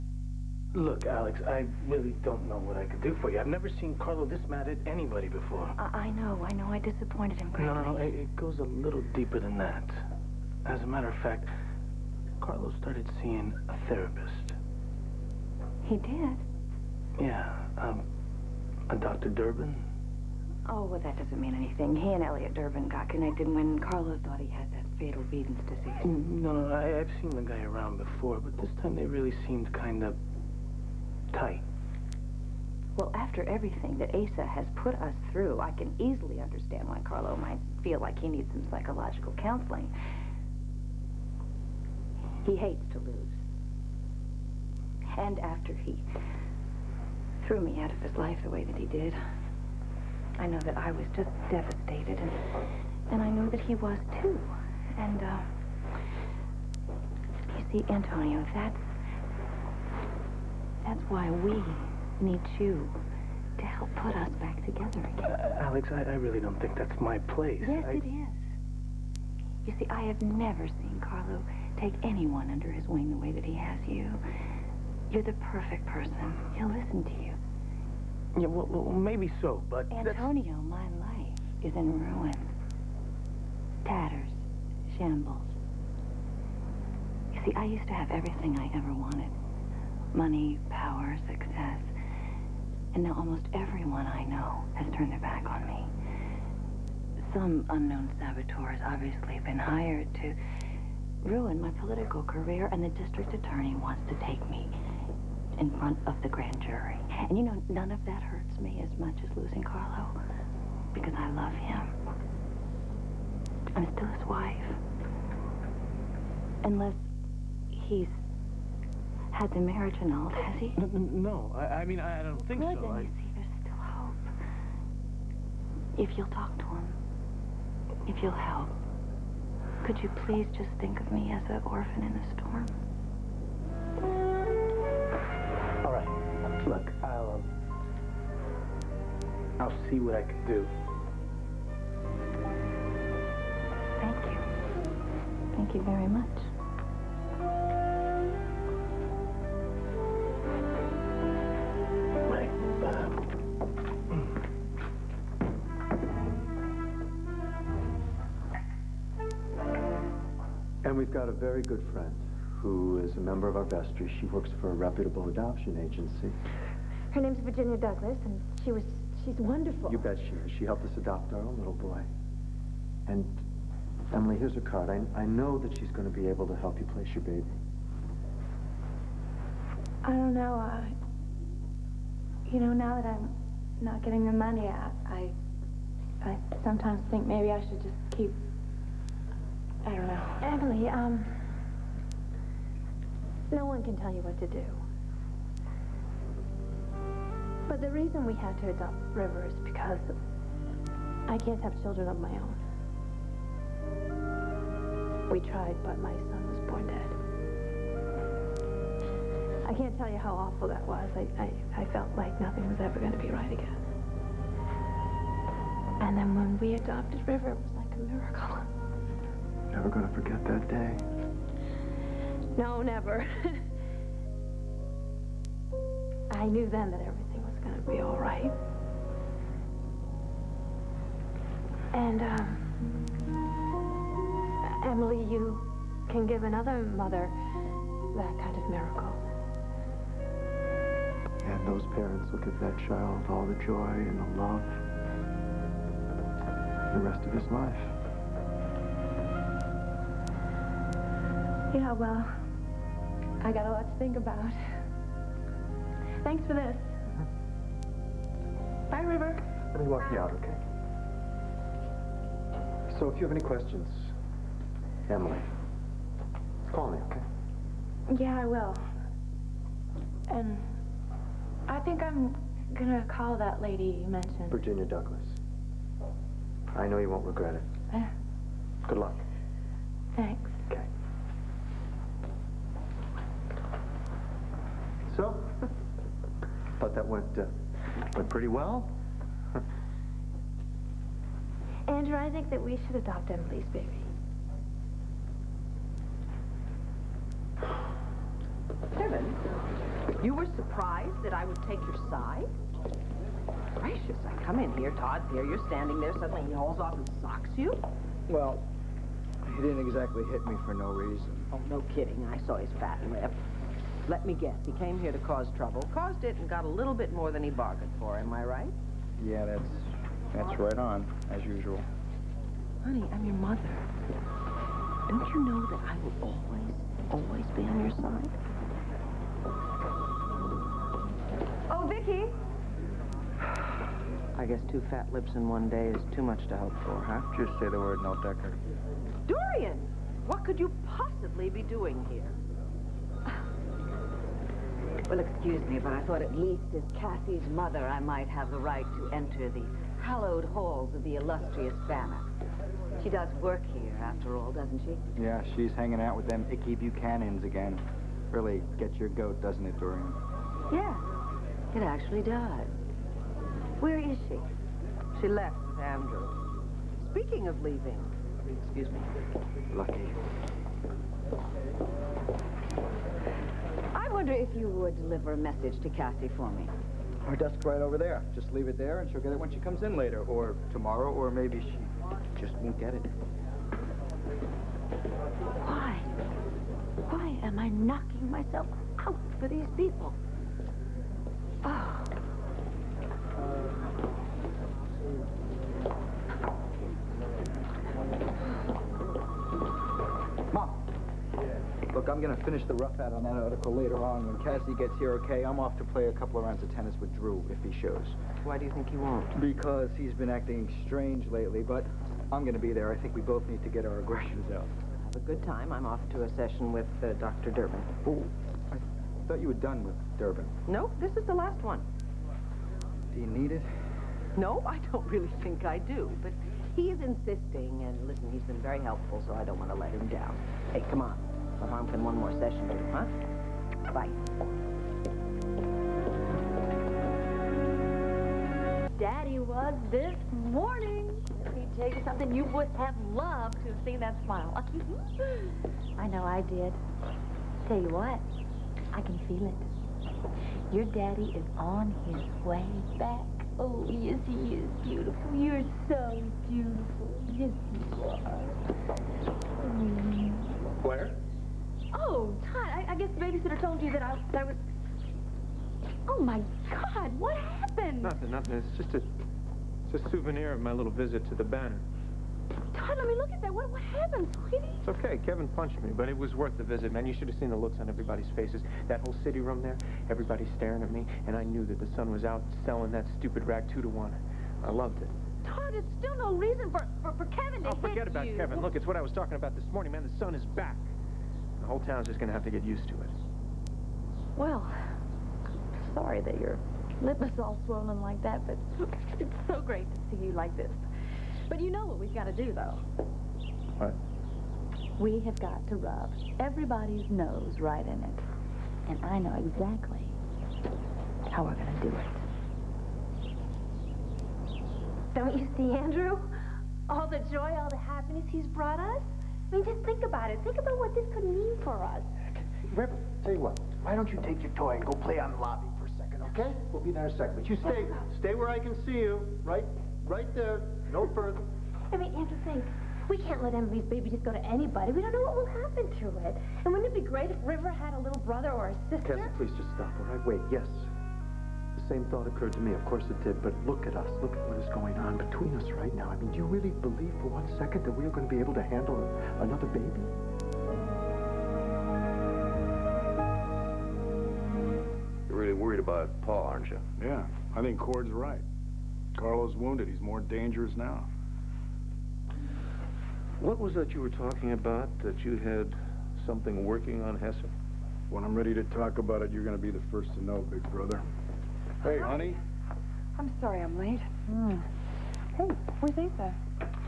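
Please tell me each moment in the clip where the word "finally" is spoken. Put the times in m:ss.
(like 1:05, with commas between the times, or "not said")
not said.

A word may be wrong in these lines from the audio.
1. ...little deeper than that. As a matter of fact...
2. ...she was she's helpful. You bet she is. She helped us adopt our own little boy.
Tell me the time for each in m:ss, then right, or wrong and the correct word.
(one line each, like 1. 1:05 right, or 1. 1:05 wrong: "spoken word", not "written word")
1. 0:08 right
2. 2:48 wrong: "wonderful", not "helpful".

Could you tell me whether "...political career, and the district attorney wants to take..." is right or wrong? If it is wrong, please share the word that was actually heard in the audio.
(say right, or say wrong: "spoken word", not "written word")
right.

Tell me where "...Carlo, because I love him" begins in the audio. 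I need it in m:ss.
1:49.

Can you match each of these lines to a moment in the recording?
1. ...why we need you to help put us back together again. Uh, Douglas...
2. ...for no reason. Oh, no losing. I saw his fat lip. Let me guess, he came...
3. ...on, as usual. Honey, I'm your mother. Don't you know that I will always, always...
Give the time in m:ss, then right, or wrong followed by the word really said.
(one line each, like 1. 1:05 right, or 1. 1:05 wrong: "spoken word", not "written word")
1. 1:01 wrong: "Alex", not "Douglas"
2. 5:10 wrong: "kidding", not "losing"
3. 5:20 right.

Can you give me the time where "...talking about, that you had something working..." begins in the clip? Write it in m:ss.
9:24.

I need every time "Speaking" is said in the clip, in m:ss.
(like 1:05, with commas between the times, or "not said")
6:07.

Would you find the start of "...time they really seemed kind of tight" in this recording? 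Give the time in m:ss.
0:28.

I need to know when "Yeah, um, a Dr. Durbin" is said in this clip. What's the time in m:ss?
0:17.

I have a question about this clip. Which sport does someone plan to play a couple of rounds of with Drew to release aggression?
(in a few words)
Tennis.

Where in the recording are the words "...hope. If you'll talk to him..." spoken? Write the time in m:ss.
2:03.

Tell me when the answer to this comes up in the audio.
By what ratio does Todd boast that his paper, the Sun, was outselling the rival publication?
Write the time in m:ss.
8:03.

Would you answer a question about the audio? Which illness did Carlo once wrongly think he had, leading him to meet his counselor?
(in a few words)
Beden's disease.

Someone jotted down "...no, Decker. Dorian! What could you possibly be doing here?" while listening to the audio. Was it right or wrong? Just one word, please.
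right.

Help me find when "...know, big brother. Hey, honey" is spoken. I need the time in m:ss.
9:30.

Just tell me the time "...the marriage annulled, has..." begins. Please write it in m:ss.
1:59.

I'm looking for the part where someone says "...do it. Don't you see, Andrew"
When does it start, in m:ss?
8:31.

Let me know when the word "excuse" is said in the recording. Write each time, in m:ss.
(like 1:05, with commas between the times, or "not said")
5:45, 6:08.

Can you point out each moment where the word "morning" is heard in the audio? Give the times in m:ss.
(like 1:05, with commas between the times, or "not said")
7:20, 8:09.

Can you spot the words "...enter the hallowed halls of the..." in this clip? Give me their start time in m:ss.
5:49.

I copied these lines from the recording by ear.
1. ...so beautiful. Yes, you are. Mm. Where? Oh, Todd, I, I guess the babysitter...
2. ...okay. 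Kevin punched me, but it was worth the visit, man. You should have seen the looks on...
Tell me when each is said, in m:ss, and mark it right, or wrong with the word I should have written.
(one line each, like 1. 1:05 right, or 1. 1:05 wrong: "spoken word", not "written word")
1. 7:35 right
2. 7:54 right.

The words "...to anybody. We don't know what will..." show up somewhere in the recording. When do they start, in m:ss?
8:54.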